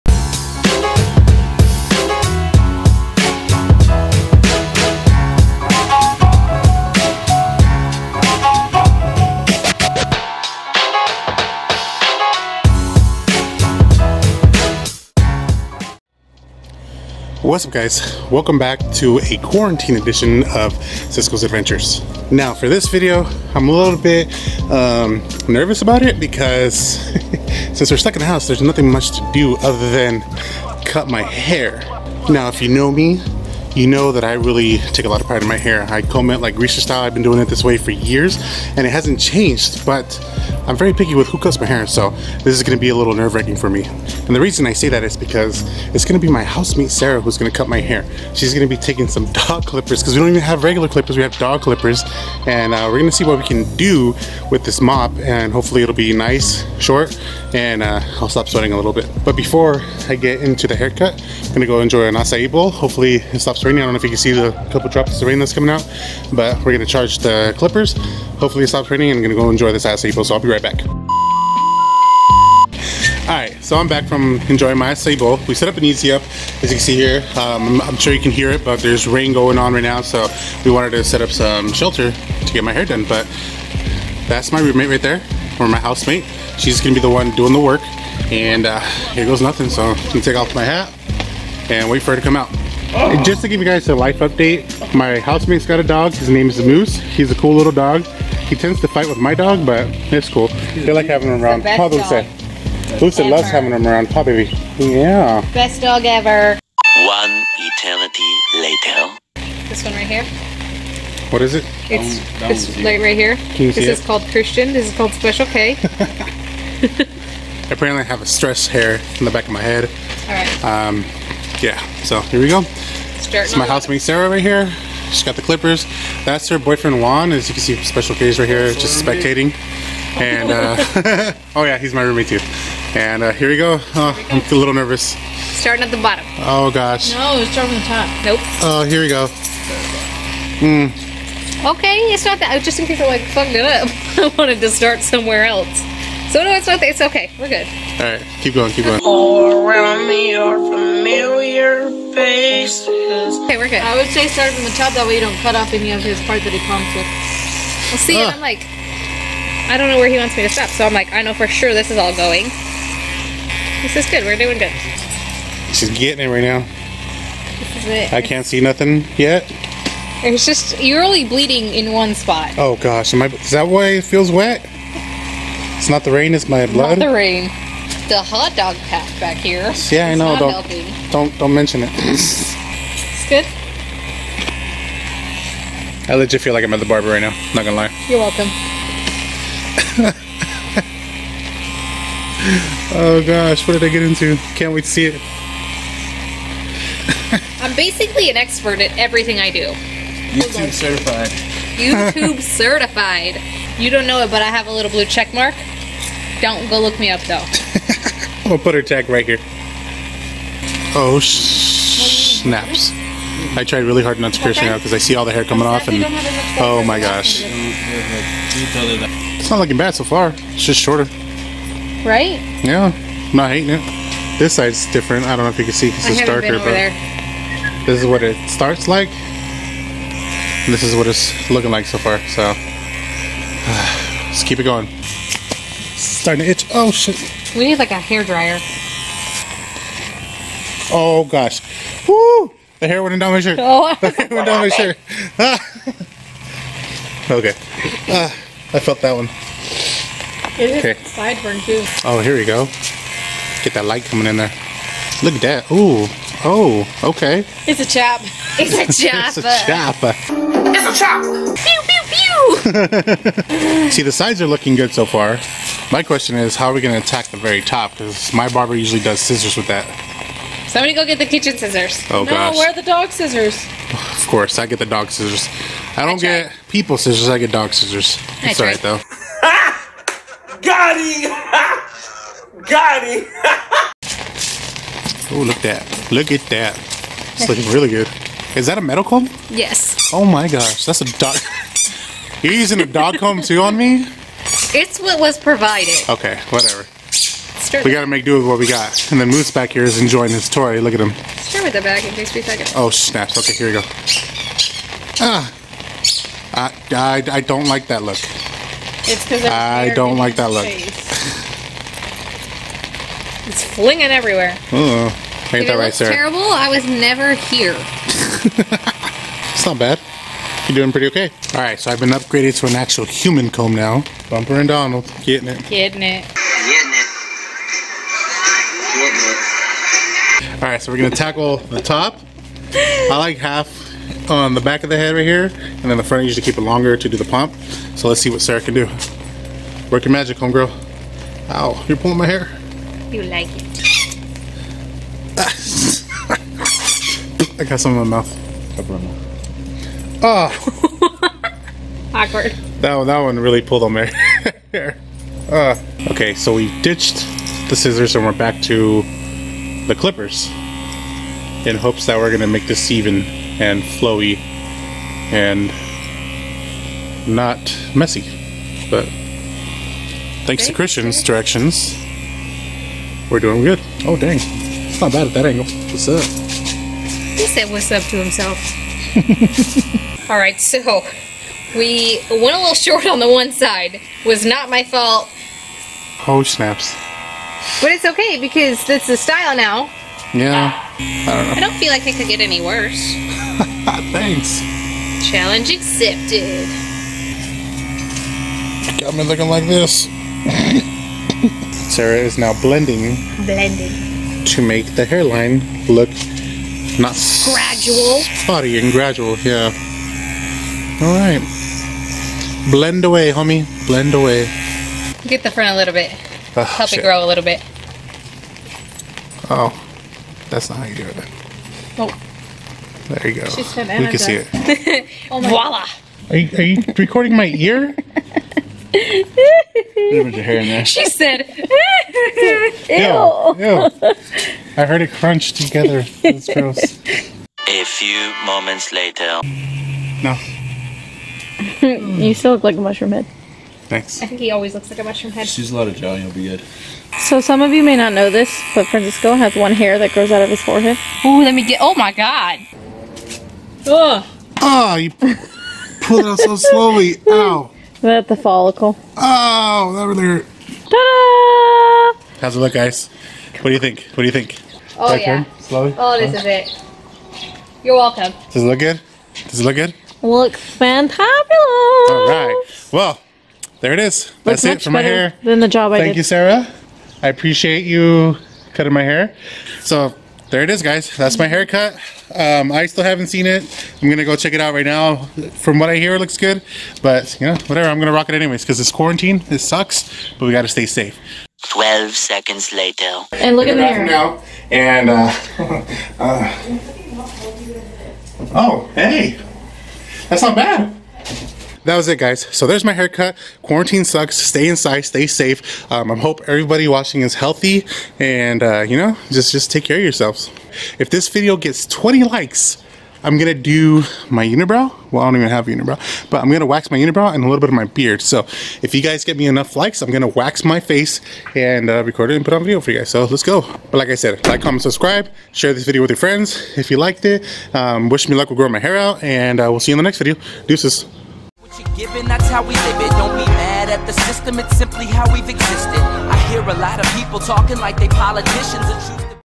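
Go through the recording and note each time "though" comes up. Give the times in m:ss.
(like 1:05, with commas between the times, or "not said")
3:27, 4:38.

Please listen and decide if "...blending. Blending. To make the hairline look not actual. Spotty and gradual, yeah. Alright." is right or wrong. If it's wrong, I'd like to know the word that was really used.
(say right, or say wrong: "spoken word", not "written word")
wrong: "gradual", not "actual".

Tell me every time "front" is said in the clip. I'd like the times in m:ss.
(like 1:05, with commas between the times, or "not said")
5:36, 6:55.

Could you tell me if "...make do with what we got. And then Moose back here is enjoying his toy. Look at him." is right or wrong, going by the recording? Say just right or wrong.
right.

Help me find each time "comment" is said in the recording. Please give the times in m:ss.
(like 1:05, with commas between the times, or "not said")
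8:44.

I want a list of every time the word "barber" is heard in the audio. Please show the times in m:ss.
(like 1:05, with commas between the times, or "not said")
3:06, 4:28.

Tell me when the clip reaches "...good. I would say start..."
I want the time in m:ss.
2:33.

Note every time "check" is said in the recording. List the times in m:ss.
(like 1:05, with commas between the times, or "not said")
3:25, 8:04.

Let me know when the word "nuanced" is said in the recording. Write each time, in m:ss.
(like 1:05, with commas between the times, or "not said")
not said.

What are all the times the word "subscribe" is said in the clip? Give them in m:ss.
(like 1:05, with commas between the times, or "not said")
8:44.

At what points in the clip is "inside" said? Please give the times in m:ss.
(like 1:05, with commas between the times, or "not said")
8:24.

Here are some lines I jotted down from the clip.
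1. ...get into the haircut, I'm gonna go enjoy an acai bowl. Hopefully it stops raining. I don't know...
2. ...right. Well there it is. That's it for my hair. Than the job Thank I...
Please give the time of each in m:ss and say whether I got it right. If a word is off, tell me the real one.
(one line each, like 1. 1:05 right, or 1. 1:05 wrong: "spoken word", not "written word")
1. 1:00 right
2. 7:52 right.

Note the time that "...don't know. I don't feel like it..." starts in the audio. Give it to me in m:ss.
6:31.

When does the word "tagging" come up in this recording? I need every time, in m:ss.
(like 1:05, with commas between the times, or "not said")
not said.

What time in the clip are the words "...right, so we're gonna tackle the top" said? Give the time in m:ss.
5:30.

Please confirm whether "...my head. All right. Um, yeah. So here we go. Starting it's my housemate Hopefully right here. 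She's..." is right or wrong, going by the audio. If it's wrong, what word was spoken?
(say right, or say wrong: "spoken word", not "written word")
wrong: "Sarah", not "Hopefully".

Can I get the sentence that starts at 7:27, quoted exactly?
So some of you may not know this, but Francisco has one hair that grows out of his forehead.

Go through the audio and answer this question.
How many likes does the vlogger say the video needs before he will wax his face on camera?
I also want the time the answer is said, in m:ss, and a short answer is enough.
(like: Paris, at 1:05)
20, at 8:31.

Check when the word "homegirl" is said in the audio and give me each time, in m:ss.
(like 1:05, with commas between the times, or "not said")
5:40.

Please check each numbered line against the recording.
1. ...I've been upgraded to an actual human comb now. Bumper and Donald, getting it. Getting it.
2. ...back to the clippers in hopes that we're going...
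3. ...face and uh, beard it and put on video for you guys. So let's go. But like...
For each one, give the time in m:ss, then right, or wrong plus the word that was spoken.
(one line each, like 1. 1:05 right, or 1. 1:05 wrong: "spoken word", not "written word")
1. 5:21 right
2. 5:58 right
3. 8:40 wrong: "record", not "beard".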